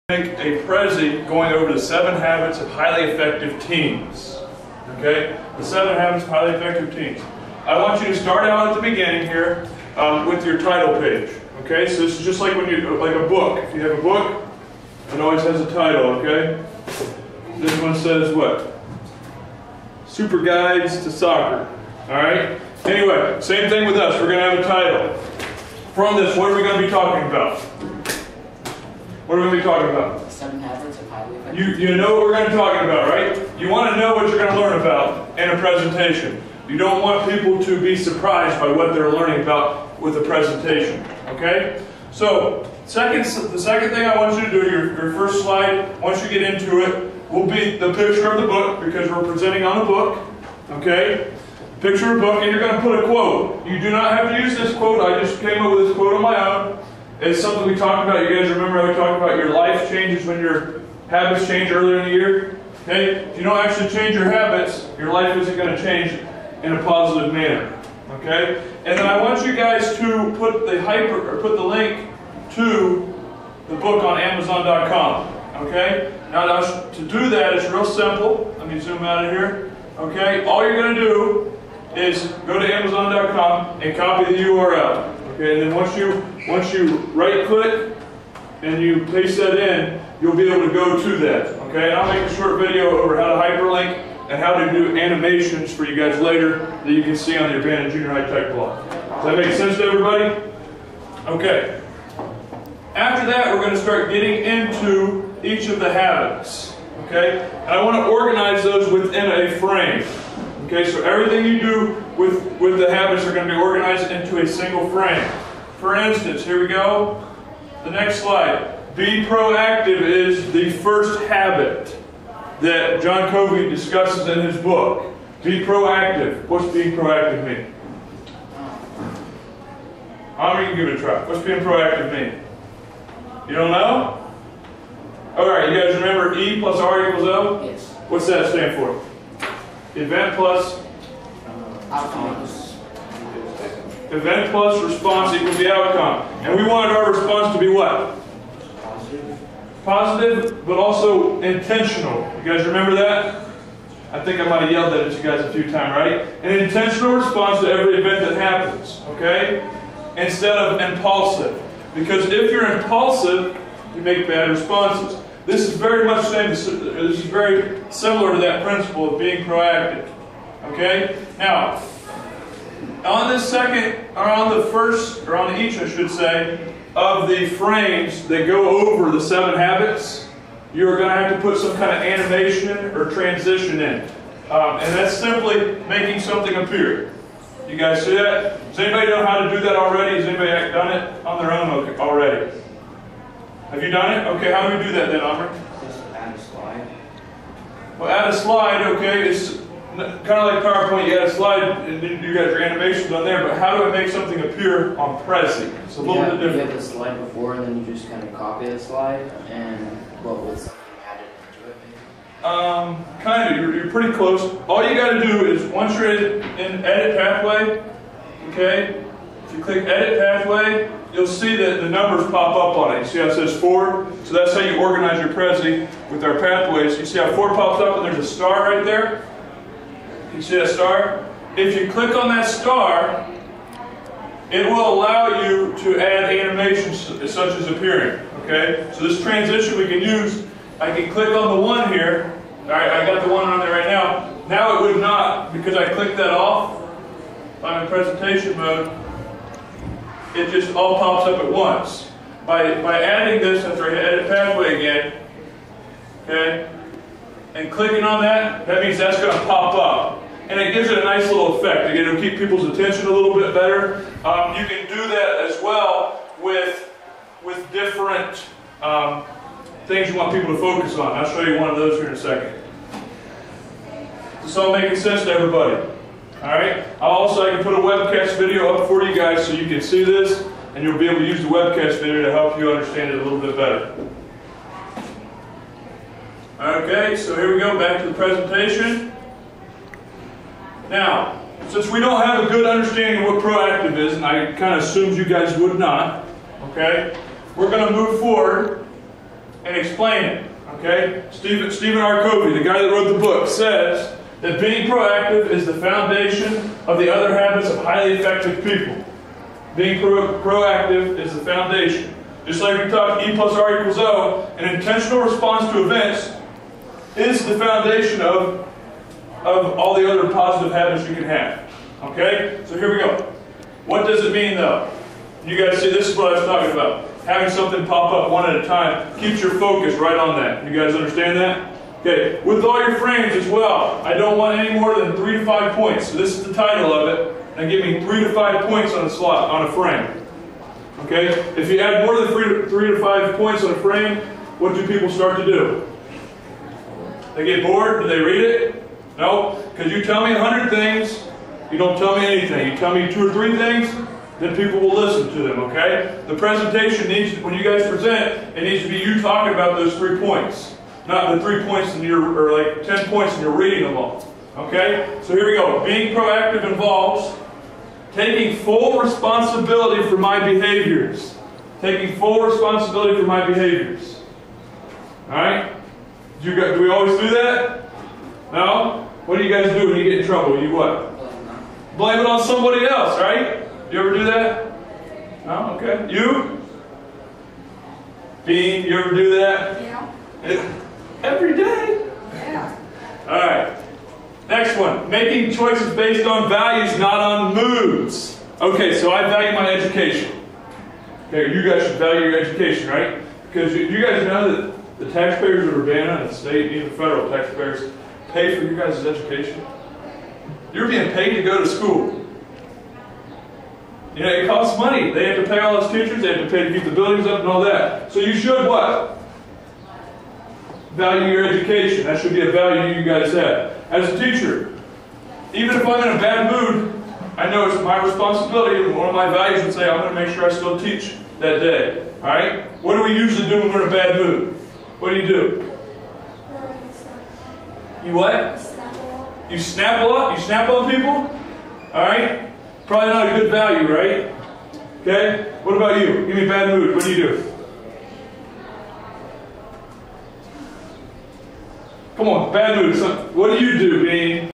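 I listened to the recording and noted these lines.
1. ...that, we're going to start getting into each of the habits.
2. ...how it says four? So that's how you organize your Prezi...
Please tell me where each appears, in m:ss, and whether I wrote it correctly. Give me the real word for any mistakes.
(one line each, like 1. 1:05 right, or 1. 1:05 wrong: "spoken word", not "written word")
1. 1:43 right
2. 3:43 right.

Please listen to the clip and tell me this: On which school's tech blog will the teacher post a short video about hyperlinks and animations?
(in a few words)
Urbana Junior High.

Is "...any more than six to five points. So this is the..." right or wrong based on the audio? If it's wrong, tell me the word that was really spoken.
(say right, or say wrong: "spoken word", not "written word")
wrong: "three", not "six".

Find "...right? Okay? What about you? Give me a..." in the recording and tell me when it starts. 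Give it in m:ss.
7:23.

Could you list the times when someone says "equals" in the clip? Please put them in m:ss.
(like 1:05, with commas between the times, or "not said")
2:17, 2:25, 5:13.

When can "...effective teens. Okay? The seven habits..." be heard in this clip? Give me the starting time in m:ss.
0:03.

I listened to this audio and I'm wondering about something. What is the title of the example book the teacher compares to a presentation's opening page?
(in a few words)
Super Guides to Soccer.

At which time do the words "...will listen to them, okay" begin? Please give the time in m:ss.
5:54.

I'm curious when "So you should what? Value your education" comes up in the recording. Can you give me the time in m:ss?
6:58.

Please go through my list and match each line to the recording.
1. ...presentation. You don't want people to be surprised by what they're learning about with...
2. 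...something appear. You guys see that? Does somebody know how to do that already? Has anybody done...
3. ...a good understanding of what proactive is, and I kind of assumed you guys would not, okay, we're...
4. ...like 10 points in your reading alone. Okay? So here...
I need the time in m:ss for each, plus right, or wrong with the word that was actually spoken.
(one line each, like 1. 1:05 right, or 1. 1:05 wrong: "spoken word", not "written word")
1. 0:35 right
2. 3:06 wrong: "anybody", not "somebody"
3. 4:52 right
4. 6:02 right.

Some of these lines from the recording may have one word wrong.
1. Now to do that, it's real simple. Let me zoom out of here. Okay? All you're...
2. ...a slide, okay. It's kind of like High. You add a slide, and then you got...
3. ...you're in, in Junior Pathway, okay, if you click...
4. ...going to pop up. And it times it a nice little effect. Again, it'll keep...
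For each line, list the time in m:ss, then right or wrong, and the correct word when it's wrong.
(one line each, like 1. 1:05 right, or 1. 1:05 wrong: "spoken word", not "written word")
1. 1:16 right
2. 3:18 wrong: "PowerPoint", not "High"
3. 3:35 wrong: "Edit", not "Junior"
4. 4:19 wrong: "gives", not "times".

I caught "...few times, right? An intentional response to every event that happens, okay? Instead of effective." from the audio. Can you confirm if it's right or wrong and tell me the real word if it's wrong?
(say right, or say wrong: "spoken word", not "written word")
wrong: "impulsive", not "effective".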